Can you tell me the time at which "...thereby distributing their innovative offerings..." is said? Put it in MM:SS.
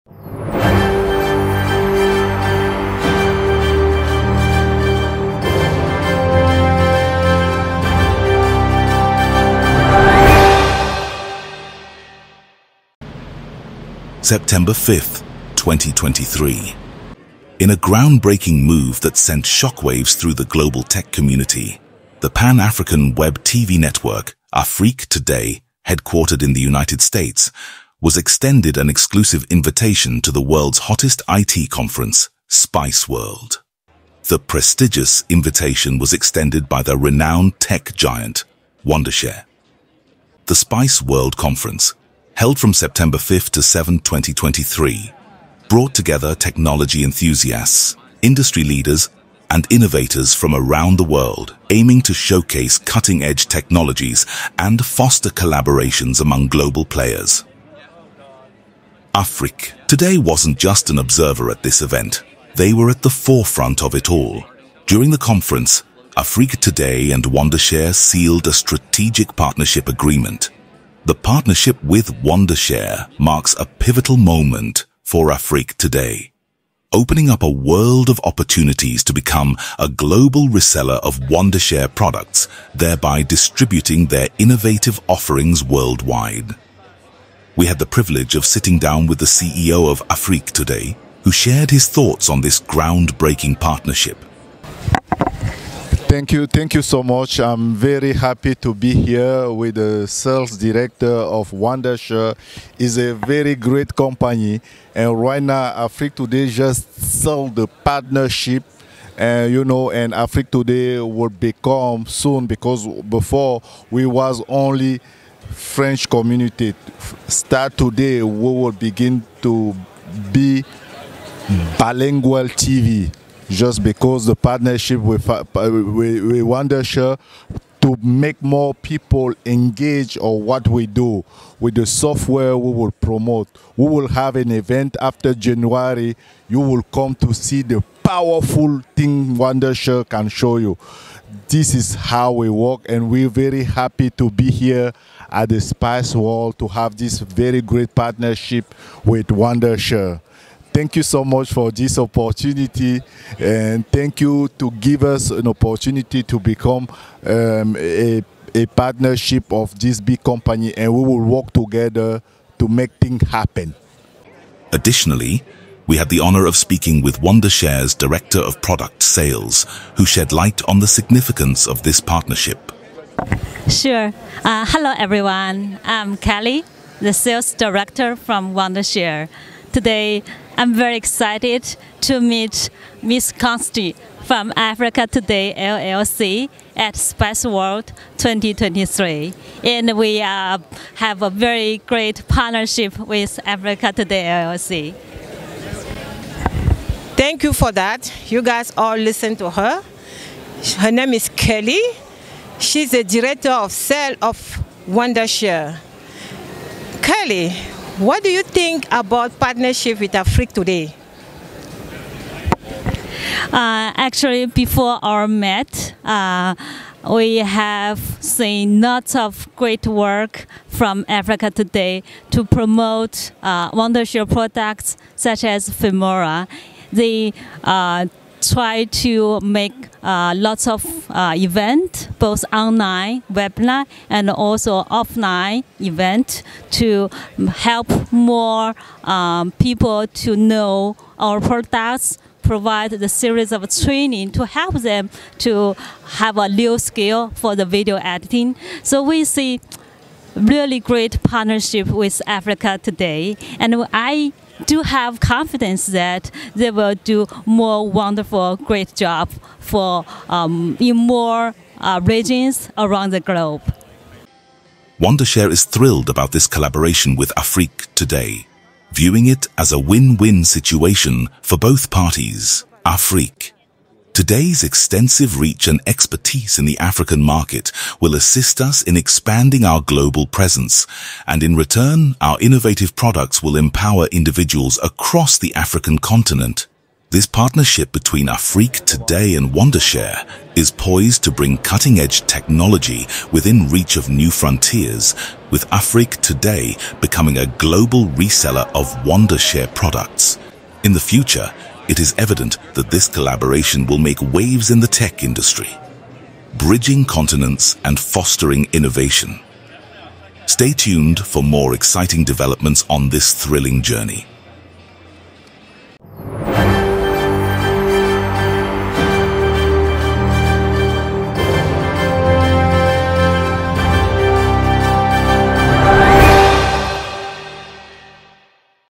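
01:22.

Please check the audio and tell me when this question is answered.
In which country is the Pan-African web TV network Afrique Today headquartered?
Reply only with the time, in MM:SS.
00:26.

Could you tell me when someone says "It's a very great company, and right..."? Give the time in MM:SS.
01:42.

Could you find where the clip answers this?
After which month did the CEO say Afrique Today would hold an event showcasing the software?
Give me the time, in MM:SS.
02:15.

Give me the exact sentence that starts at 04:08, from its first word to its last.
So we see really great partnership with Africa today.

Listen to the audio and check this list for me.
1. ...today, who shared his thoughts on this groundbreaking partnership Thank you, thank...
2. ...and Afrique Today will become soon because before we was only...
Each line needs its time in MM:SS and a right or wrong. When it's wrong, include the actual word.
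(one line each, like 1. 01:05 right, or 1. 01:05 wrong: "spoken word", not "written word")
1. 01:30 right
2. 01:49 right.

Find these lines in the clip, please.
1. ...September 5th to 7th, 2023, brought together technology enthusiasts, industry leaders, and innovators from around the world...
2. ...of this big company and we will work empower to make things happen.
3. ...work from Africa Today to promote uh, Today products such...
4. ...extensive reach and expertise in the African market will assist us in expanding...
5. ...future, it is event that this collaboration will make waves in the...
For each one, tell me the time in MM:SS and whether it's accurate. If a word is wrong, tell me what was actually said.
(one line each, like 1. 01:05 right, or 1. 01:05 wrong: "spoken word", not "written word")
1. 00:42 right
2. 02:39 wrong: "together", not "empower"
3. 03:39 wrong: "Wondershare", not "Today"
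4. 04:34 right
5. 05:00 wrong: "evident", not "event".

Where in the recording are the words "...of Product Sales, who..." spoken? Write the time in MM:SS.
02:48.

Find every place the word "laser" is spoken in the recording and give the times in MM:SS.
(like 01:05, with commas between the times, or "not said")
not said.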